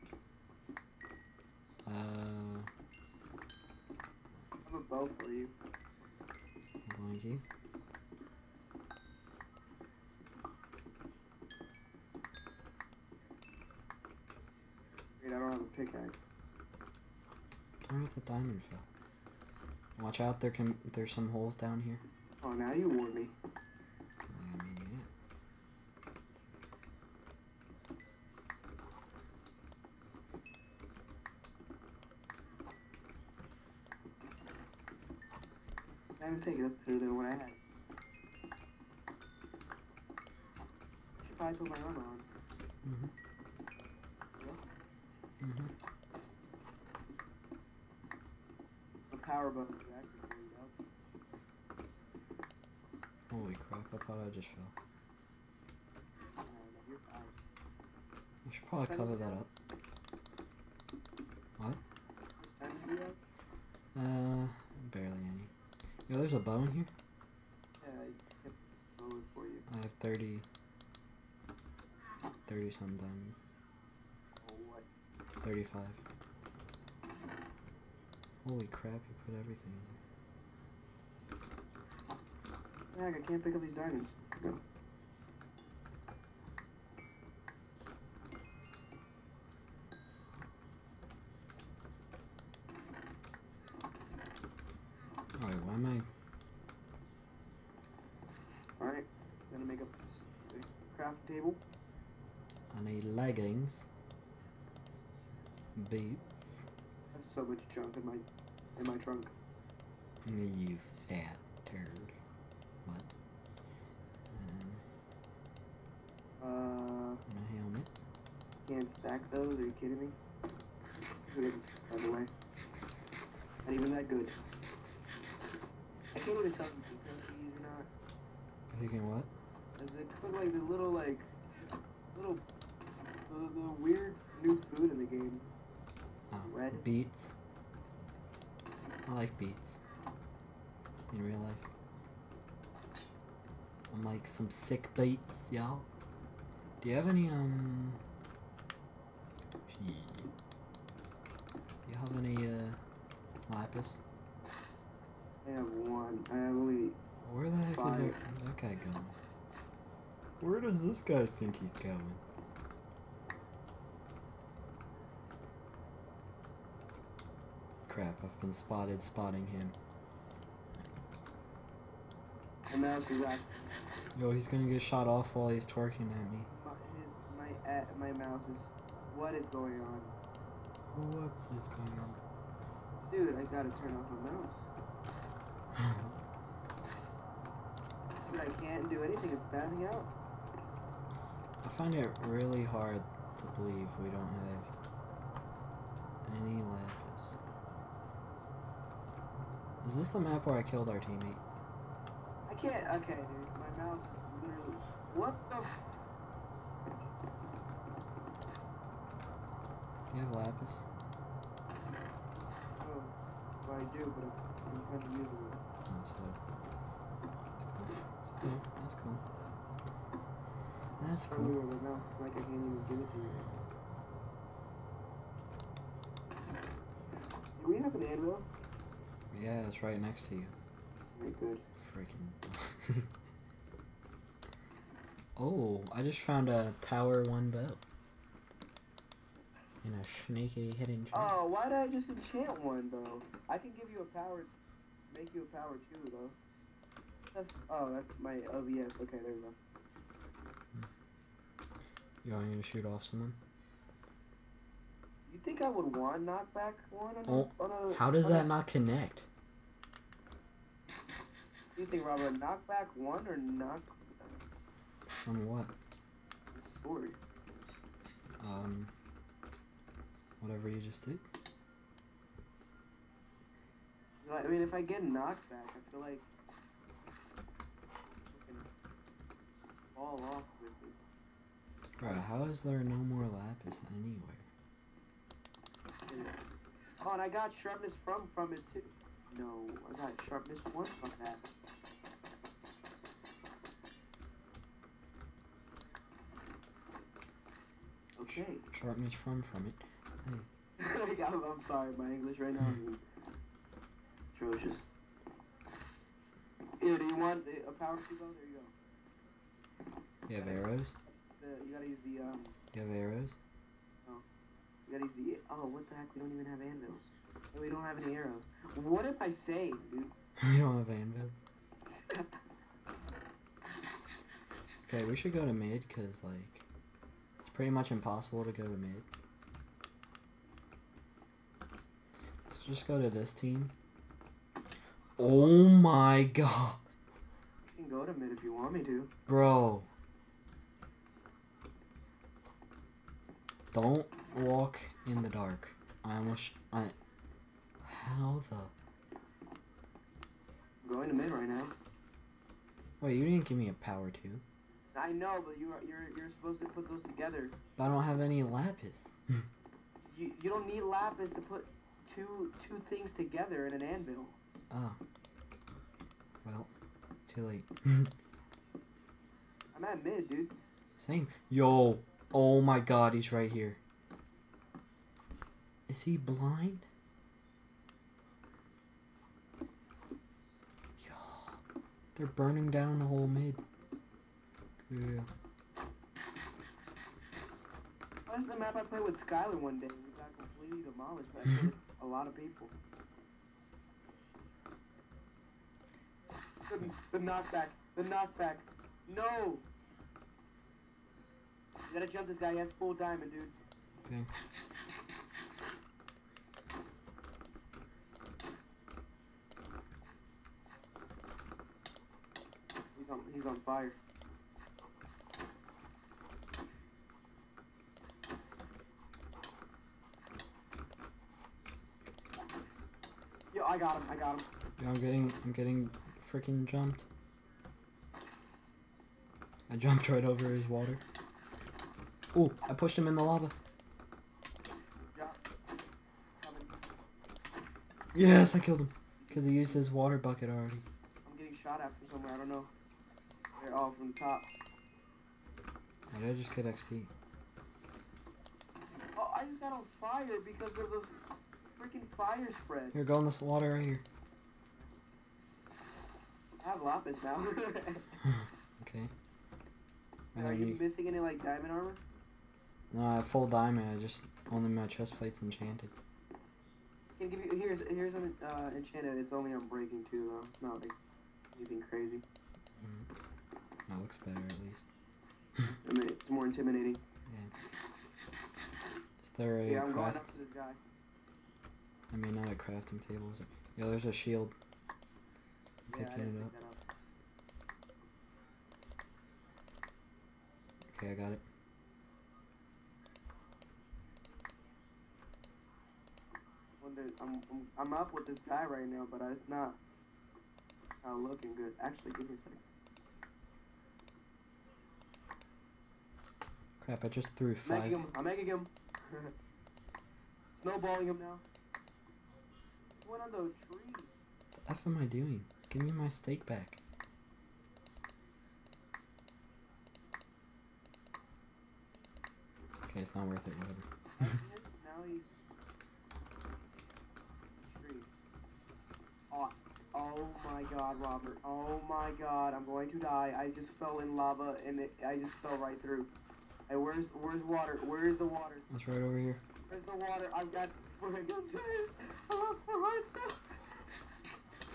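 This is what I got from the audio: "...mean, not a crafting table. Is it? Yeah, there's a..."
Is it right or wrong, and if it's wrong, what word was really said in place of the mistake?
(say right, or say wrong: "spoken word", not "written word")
right.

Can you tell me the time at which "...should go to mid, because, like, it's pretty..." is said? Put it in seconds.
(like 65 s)
325 s.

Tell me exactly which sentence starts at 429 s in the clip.
I jumped right over his water.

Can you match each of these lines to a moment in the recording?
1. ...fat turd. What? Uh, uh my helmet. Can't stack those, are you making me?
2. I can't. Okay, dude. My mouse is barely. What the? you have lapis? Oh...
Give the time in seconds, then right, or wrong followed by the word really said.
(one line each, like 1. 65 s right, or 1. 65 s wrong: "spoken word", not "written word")
1. 111 s wrong: "kidding", not "making"
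2. 202 s wrong: "literally", not "barely".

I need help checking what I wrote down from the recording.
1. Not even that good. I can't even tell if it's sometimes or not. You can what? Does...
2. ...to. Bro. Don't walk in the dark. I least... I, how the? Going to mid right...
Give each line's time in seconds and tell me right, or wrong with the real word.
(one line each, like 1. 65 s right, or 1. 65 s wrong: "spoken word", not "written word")
1. 123 s wrong: "cookies", not "sometimes"
2. 338 s wrong: "almost", not "least".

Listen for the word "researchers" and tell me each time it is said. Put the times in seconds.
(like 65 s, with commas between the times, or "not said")
not said.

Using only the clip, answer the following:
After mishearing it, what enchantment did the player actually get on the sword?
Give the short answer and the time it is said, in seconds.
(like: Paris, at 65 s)
sharpness one, at 290 s.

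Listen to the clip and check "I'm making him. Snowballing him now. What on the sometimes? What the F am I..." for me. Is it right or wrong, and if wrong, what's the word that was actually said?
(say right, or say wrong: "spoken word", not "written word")
wrong: "trees", not "sometimes".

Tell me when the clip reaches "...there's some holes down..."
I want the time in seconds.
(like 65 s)
20 s.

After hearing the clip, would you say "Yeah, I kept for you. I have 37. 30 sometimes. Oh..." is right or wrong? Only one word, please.
wrong.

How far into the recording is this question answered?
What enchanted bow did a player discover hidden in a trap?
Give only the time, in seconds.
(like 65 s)
236 s.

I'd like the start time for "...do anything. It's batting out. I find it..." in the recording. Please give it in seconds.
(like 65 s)
188 s.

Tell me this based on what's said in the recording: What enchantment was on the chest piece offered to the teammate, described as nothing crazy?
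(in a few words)
Unbreaking.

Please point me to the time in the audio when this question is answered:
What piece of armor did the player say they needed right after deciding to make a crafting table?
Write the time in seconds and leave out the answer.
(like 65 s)
103 s.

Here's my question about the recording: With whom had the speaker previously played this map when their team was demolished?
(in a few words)
Skylar.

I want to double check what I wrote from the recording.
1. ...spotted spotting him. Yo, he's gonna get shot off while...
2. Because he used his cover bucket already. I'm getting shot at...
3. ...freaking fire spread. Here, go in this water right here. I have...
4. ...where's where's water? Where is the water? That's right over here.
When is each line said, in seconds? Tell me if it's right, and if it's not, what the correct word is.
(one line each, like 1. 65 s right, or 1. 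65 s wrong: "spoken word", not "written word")
1. 168 s right
2. 439 s wrong: "water", not "cover"
3. 451 s right
4. 536 s right.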